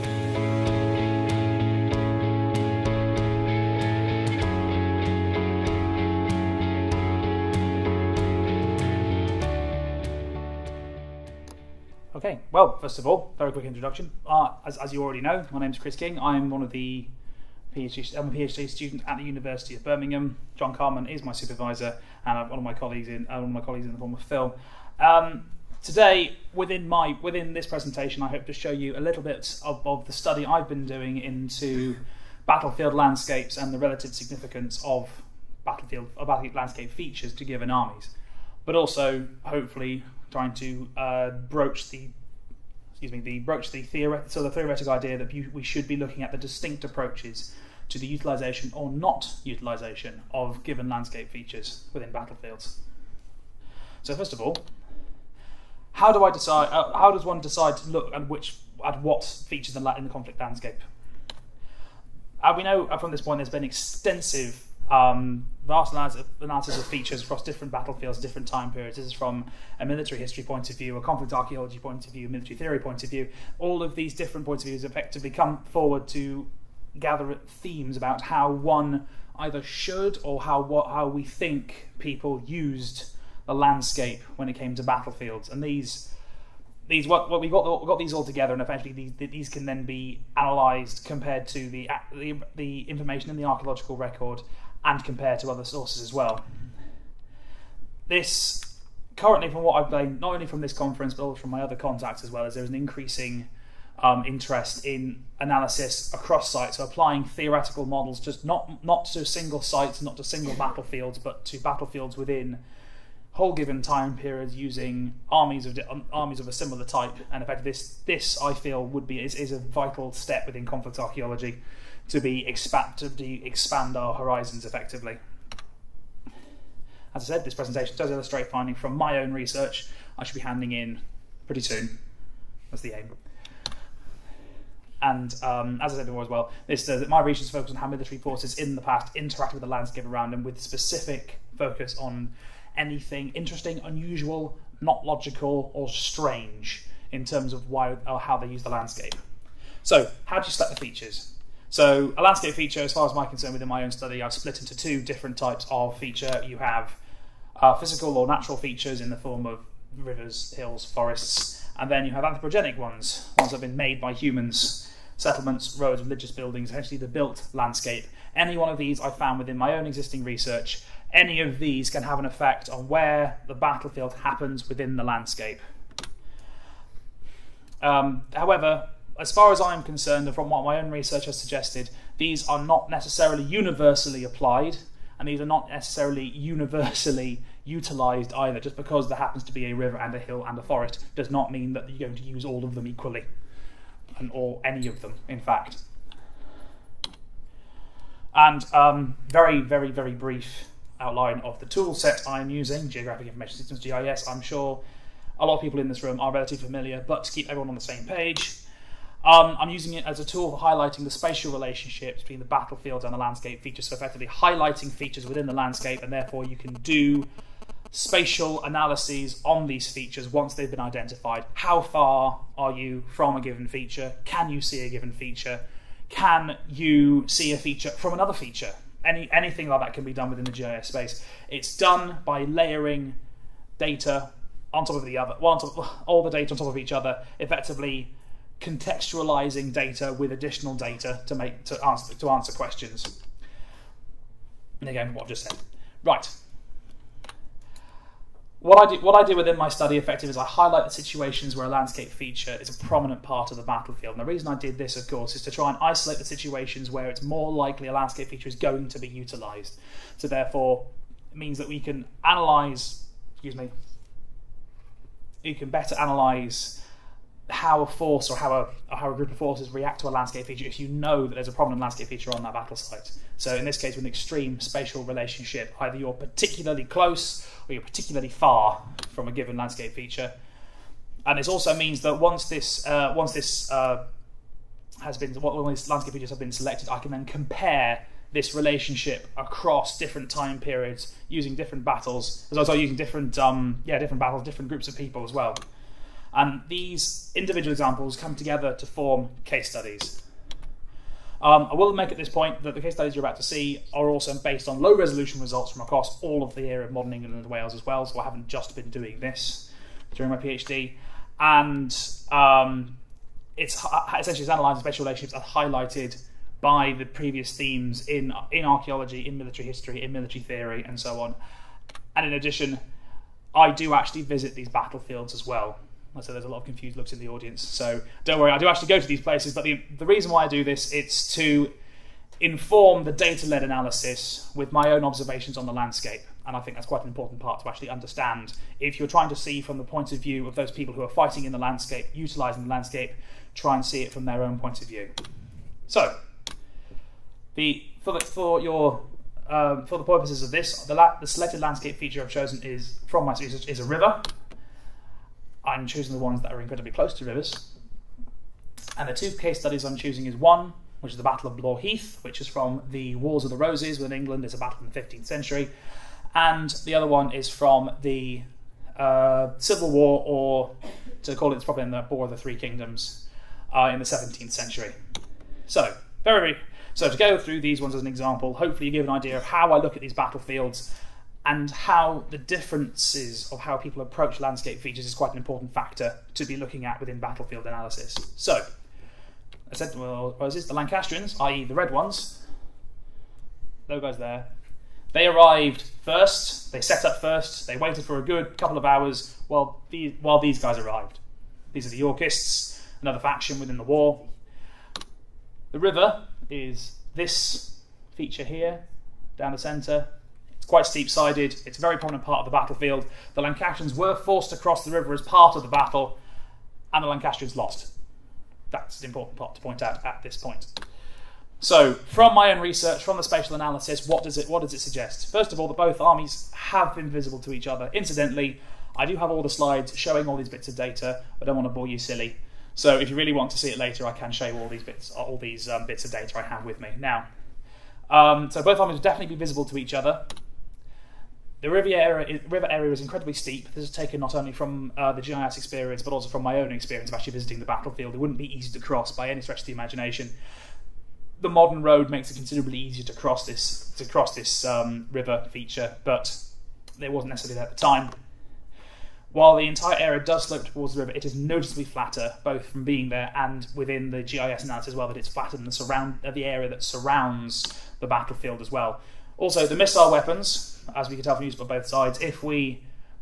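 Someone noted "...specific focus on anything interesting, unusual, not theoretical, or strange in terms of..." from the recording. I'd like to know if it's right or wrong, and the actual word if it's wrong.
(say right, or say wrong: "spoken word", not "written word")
wrong: "logical", not "theoretical".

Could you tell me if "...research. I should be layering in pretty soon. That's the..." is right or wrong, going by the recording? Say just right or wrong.
wrong.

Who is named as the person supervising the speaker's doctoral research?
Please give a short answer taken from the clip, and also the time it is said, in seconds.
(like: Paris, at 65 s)
John Carman, at 20 s.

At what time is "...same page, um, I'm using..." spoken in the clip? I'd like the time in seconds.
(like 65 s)
207 s.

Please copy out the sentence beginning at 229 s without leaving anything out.
Any, anything like that can be done within the GIS space.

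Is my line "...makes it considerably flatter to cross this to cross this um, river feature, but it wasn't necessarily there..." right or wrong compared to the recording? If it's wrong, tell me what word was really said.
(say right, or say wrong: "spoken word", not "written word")
wrong: "easier", not "flatter".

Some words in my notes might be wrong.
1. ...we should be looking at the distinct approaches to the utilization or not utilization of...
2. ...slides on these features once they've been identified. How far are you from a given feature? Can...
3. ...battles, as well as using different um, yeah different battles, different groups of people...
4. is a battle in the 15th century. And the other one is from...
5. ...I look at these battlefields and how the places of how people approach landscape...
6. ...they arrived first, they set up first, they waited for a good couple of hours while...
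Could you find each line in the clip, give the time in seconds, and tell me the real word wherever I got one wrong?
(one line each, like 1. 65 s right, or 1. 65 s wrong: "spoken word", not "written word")
1. 45 s right
2. 218 s wrong: "analyses", not "slides"
3. 291 s right
4. 364 s right
5. 379 s wrong: "differences", not "places"
6. 395 s right.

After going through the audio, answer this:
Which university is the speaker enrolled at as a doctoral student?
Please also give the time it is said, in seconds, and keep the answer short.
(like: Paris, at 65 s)
University of Birmingham, at 19 s.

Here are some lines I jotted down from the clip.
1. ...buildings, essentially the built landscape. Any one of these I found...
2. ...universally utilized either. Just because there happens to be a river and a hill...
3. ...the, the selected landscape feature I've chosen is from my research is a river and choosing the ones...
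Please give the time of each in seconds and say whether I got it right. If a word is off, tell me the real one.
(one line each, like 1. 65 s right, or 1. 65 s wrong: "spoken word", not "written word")
1. 166 s right
2. 186 s right
3. 350 s right.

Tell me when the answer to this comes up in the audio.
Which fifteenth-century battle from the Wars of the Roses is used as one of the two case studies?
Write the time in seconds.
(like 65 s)
361 s.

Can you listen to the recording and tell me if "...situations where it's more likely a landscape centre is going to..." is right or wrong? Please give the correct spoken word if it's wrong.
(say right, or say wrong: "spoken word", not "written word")
wrong: "feature", not "centre".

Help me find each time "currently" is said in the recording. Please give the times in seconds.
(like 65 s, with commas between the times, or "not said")
99 s.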